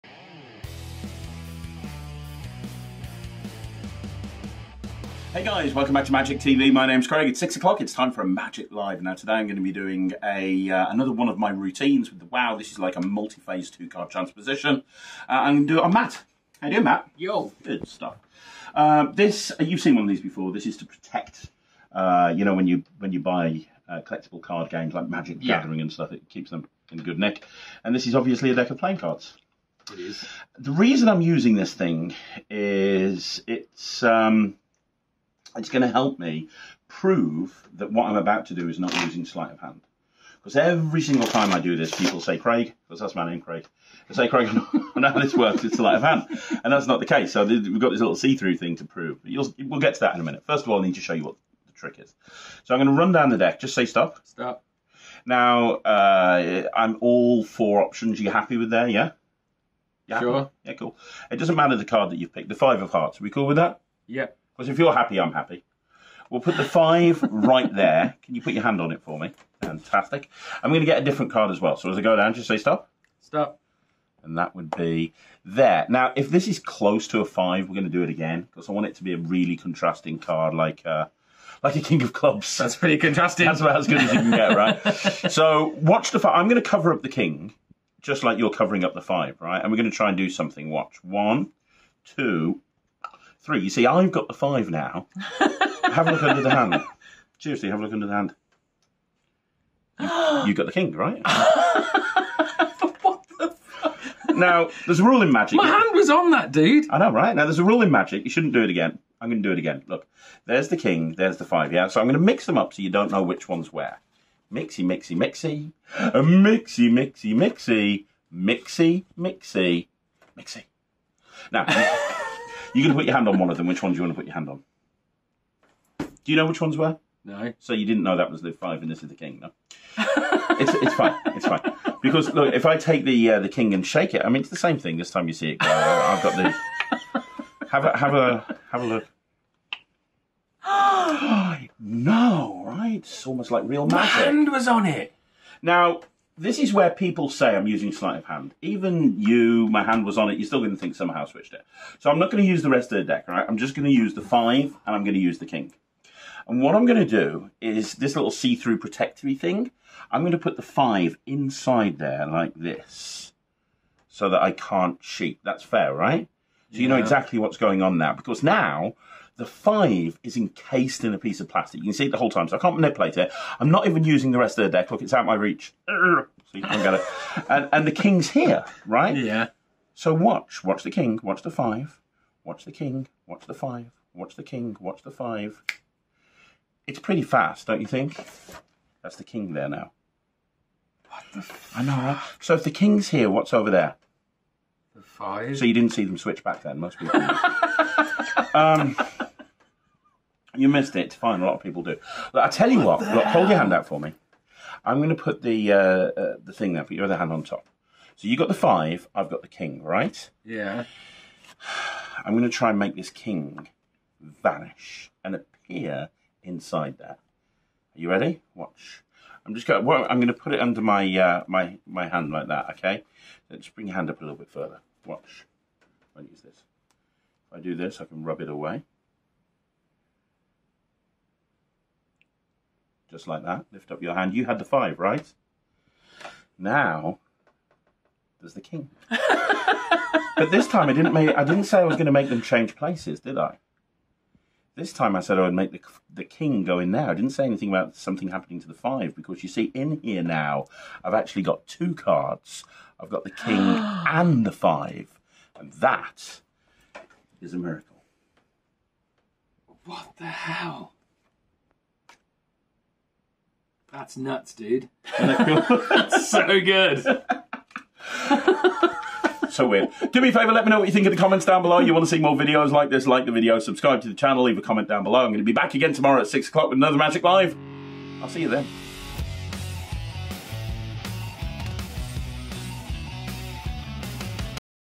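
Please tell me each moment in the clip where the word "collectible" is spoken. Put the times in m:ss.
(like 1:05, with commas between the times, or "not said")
0:23.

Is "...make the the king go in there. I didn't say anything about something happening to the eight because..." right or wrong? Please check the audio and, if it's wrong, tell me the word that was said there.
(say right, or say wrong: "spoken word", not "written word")
wrong: "five", not "eight".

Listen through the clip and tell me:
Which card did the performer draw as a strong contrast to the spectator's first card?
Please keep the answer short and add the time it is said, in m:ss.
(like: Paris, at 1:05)
King of clubs, at 1:21.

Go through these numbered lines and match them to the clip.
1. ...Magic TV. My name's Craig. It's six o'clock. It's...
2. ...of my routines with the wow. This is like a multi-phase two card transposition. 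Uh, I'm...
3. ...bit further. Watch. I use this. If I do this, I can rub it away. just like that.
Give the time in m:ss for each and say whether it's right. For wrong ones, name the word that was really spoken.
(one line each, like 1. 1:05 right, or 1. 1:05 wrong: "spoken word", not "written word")
1. 0:06 right
2. 0:11 right
3. 3:44 right.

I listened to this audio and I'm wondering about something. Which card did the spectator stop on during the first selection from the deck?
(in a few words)
Five of hearts.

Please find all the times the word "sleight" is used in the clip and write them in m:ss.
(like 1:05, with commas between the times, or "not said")
0:39, 0:45, 2:27.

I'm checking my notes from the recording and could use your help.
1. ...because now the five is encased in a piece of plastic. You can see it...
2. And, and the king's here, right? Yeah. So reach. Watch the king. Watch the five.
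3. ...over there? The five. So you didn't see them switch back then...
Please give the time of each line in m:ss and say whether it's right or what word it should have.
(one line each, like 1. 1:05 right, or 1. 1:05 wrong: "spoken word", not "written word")
1. 2:48 right
2. 2:57 wrong: "watch", not "reach"
3. 3:13 right.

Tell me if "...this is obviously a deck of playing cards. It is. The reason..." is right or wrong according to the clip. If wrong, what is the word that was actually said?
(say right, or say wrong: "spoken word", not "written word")
right.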